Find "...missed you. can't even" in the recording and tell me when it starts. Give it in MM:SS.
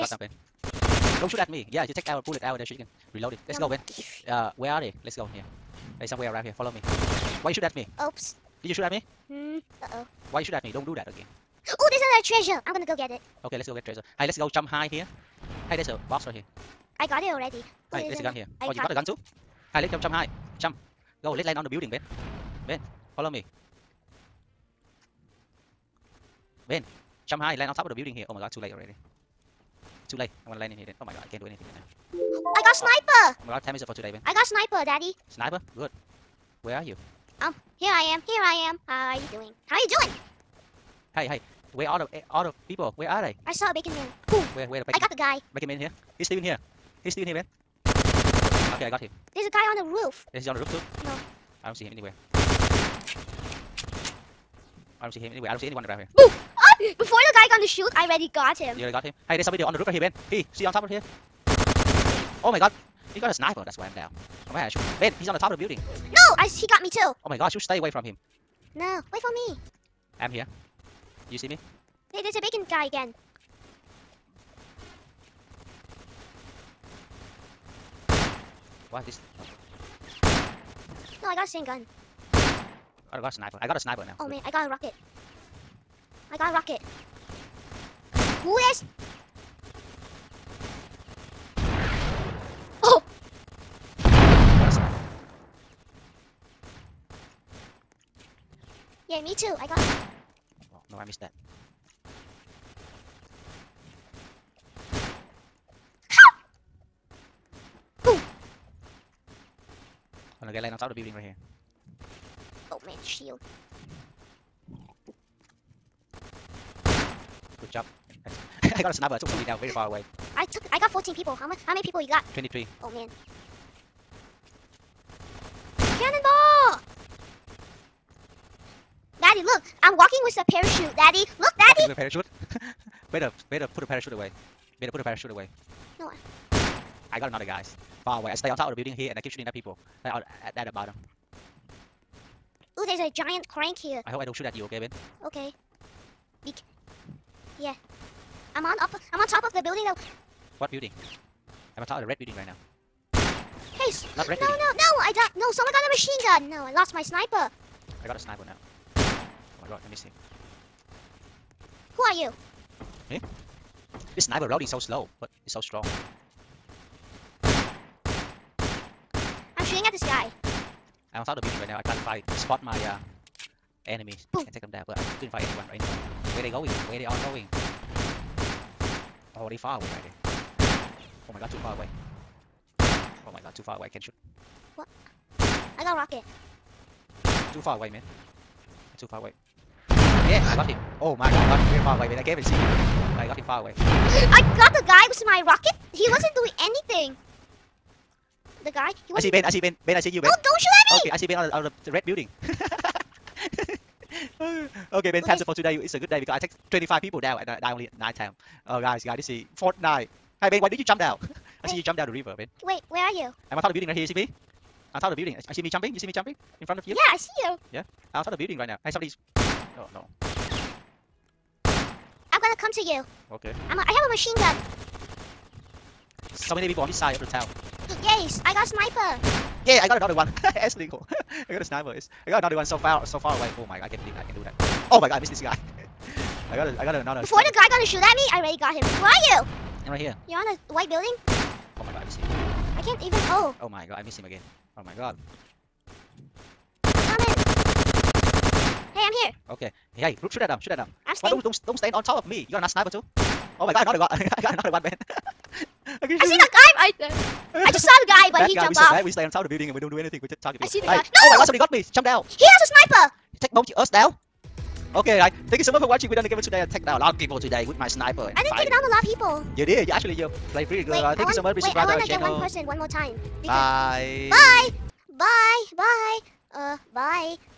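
04:02.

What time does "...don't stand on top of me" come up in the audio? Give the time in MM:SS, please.
04:11.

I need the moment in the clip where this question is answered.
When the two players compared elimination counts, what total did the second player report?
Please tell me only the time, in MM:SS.
02:02.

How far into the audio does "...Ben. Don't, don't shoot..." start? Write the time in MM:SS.
03:20.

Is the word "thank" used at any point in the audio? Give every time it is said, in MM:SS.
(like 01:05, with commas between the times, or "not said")
04:25, 04:31.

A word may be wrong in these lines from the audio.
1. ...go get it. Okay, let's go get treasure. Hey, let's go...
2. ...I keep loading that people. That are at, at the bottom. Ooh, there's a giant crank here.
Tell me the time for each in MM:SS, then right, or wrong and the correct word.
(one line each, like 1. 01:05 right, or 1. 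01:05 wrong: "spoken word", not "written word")
1. 00:12 right
2. 02:19 wrong: "shooting", not "loading".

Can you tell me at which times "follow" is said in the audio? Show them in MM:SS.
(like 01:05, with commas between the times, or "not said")
00:06, 00:23.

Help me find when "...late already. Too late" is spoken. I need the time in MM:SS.
00:28.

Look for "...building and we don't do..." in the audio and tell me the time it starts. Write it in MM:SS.
04:19.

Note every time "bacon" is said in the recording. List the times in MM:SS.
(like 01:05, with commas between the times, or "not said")
00:43, 01:12.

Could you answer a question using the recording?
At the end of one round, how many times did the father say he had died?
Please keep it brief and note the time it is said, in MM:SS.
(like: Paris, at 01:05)
9, at 03:27.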